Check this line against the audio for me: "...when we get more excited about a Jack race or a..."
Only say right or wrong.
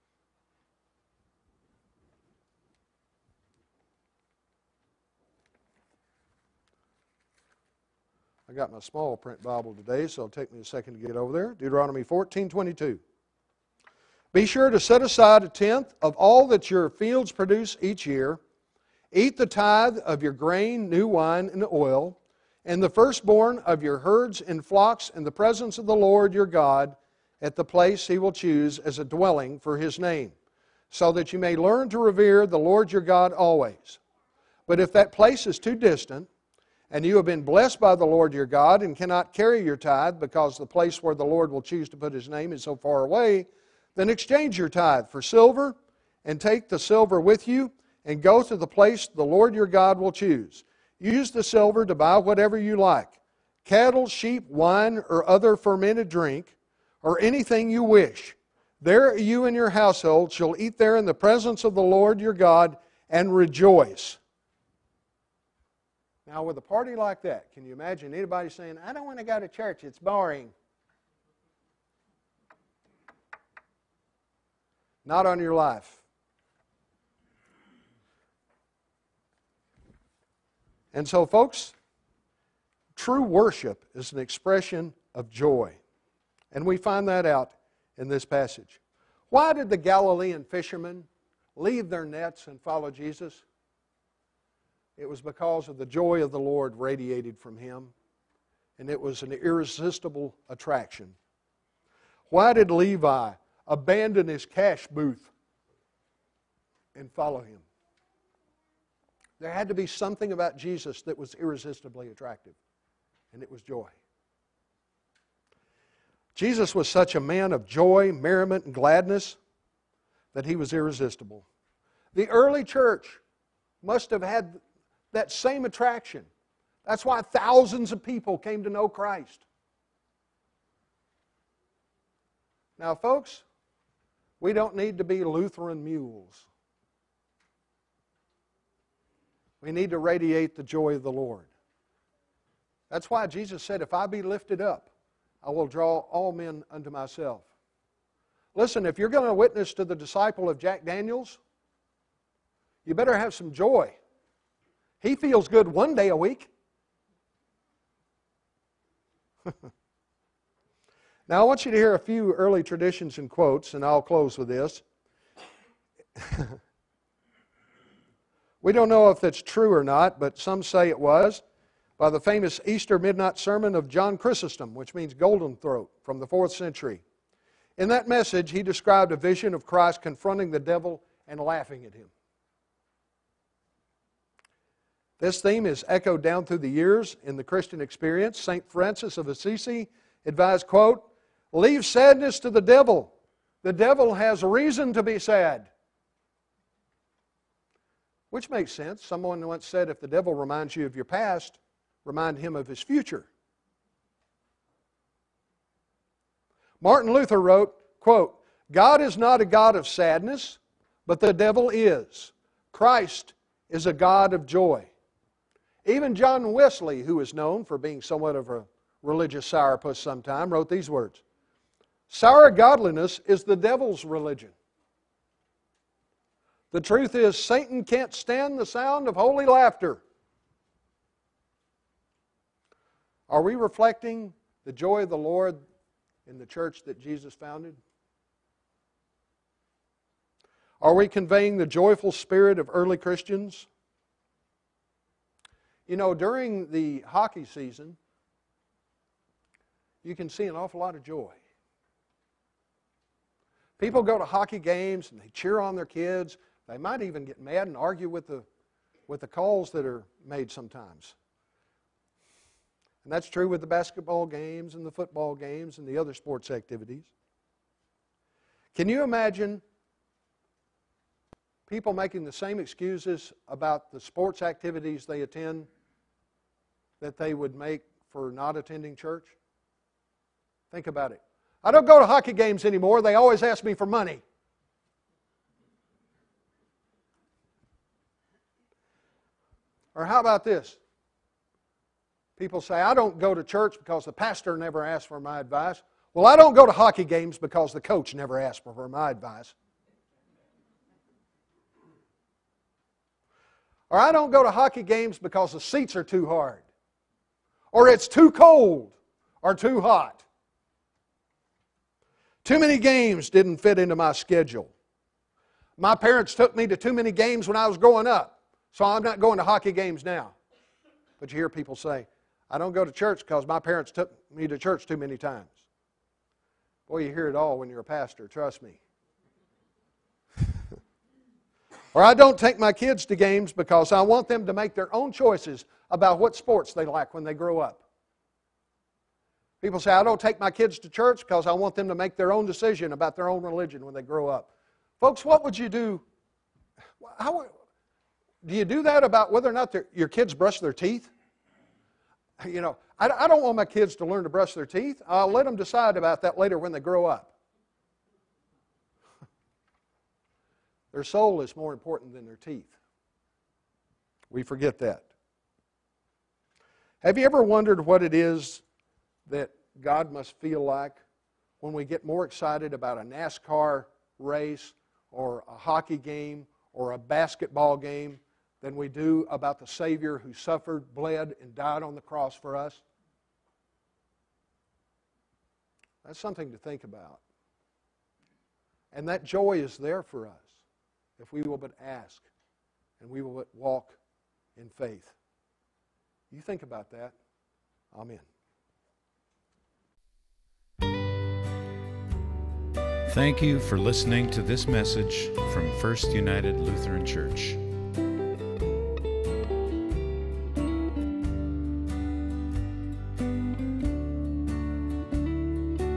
wrong.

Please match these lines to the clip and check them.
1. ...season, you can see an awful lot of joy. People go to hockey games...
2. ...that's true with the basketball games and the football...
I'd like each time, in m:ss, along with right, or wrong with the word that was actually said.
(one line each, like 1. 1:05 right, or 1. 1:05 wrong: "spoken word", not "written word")
1. 4:07 right
2. 4:23 right.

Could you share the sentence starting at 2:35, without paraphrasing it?
He feels good one day a week.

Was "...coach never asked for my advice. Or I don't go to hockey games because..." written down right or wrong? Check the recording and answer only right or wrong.
right.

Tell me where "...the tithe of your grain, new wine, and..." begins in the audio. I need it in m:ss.
0:19.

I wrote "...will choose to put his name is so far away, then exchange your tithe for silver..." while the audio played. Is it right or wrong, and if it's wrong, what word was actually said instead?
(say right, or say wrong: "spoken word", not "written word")
right.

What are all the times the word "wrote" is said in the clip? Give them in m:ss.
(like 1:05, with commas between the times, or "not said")
3:27, 3:40.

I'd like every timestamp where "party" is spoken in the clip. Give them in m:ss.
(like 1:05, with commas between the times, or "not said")
1:06.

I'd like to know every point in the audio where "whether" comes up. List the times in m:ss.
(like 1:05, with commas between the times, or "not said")
5:49.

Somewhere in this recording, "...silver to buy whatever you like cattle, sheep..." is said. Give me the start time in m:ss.
0:51.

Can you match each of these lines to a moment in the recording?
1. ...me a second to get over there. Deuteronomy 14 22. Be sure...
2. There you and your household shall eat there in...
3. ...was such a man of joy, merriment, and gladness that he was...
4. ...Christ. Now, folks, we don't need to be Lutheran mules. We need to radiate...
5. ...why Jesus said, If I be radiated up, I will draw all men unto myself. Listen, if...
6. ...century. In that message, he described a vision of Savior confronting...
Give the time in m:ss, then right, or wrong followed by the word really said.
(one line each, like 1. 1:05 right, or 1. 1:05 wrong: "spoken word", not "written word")
1. 0:10 right
2. 0:58 right
3. 1:56 right
4. 2:08 right
5. 2:23 wrong: "lifted", not "radiated"
6. 2:56 wrong: "Christ", not "Savior".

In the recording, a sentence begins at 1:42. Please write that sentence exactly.
Why did Levi abandon his cash booth and follow him?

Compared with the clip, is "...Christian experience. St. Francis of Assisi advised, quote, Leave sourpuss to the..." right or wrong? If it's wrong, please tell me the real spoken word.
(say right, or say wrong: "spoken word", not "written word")
wrong: "sadness", not "sourpuss".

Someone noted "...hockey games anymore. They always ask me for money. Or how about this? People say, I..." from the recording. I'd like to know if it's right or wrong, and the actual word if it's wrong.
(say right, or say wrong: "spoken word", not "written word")
right.